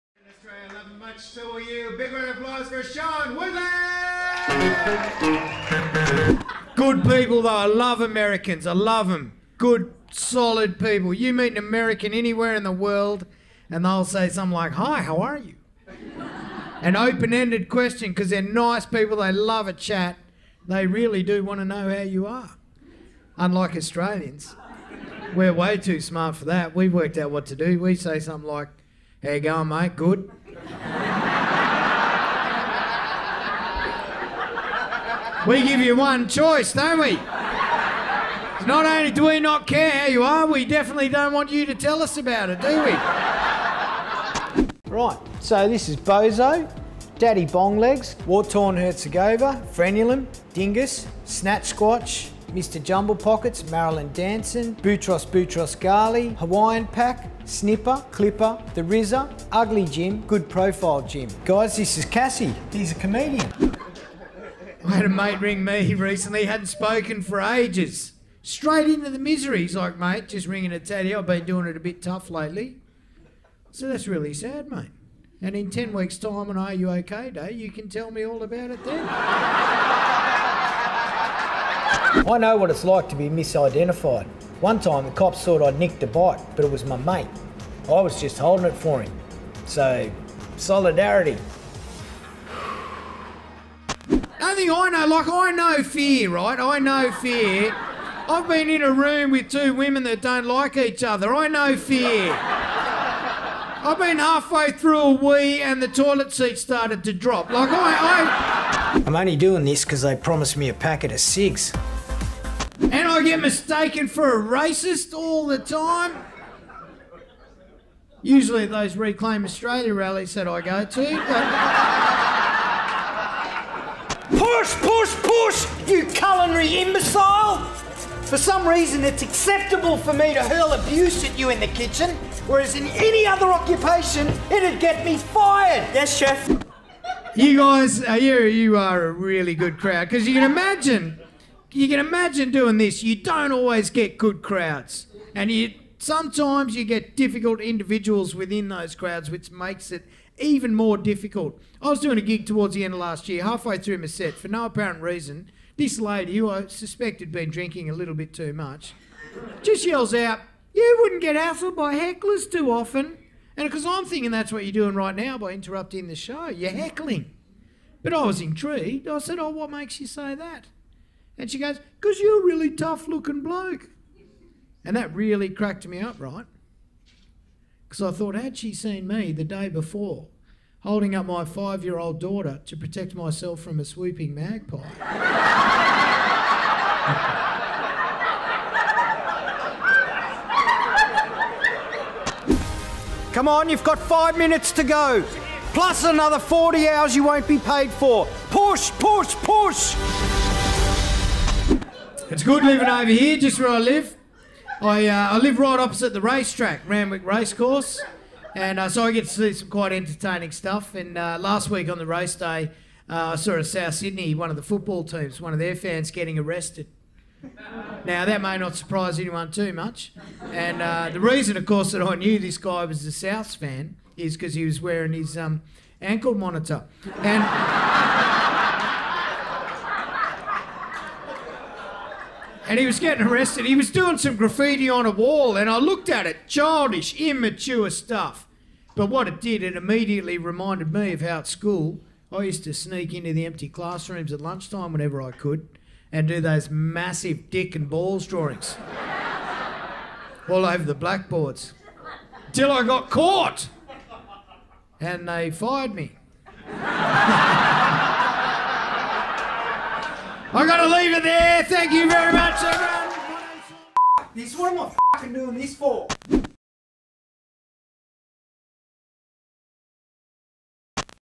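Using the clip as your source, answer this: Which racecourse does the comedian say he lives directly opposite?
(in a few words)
Randwick Racecourse.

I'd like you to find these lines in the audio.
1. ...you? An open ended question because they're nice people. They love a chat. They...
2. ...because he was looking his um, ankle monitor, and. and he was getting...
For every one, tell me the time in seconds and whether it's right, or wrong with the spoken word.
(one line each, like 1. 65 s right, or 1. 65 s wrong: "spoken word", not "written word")
1. 15 s right
2. 224 s wrong: "wearing", not "looking".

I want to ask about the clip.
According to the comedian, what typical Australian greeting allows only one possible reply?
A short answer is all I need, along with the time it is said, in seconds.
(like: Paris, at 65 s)
How you going, mate?, at 29 s.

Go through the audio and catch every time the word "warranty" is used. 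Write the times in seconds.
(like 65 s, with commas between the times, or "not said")
not said.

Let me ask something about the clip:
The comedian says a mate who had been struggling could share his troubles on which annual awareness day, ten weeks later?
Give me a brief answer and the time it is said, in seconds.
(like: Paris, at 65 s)
Are You OK Day, at 76 s.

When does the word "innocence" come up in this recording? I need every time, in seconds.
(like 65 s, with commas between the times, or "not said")
not said.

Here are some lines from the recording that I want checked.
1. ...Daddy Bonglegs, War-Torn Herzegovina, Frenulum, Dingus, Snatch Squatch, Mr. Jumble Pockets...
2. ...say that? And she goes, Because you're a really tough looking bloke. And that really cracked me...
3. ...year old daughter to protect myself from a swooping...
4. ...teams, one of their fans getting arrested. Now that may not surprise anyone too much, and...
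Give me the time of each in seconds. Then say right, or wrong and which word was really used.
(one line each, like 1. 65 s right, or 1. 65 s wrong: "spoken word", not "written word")
1. 47 s right
2. 170 s right
3. 181 s right
4. 215 s right.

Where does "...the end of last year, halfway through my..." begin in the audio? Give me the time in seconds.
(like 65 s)
152 s.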